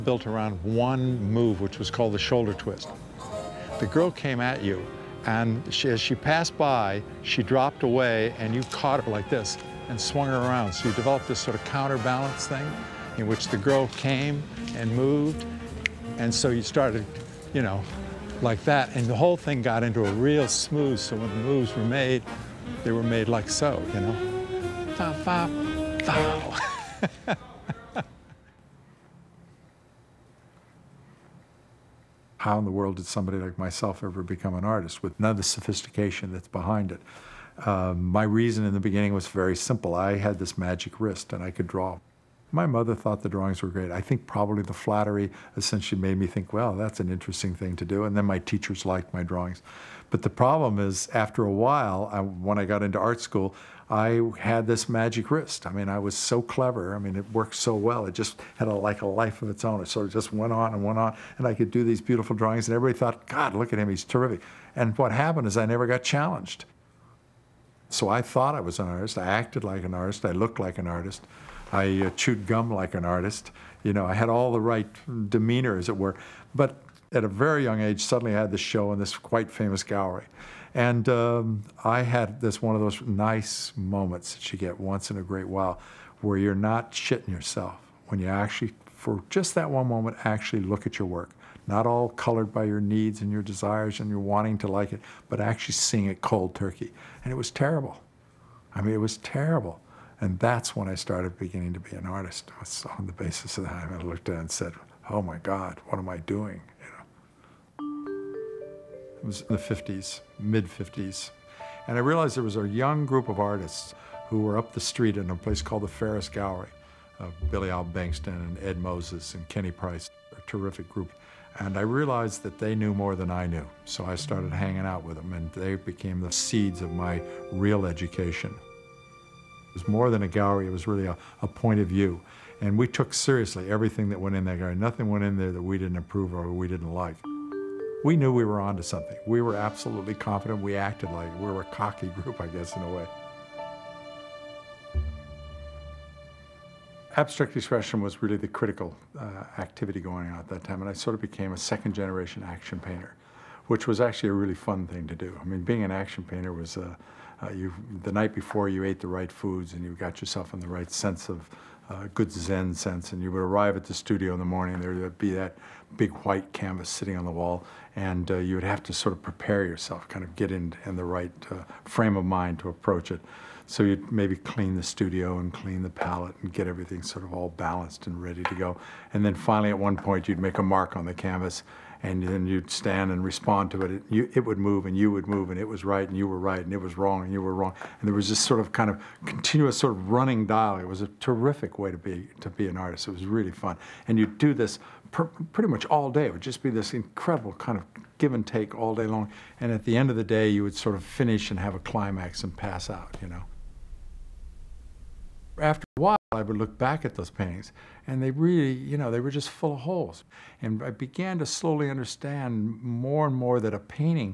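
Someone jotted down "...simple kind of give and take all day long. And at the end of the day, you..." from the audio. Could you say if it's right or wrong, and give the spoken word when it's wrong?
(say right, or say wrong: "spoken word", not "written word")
wrong: "incredible", not "simple".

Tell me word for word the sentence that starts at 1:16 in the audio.
But at a very young age, suddenly I had this show in this quite famous gallery.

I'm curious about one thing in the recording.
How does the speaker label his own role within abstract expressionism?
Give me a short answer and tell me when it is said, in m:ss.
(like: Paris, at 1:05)
second generation action painter, at 2:31.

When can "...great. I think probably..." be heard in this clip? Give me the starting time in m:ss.
0:43.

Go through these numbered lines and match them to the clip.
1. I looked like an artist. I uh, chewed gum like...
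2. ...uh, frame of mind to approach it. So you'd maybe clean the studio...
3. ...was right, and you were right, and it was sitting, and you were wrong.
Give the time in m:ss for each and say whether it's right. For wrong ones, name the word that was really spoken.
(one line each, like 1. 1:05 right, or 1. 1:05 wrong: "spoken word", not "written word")
1. 1:10 right
2. 2:51 right
3. 3:05 wrong: "wrong", not "sitting".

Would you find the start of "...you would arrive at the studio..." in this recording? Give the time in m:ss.
2:43.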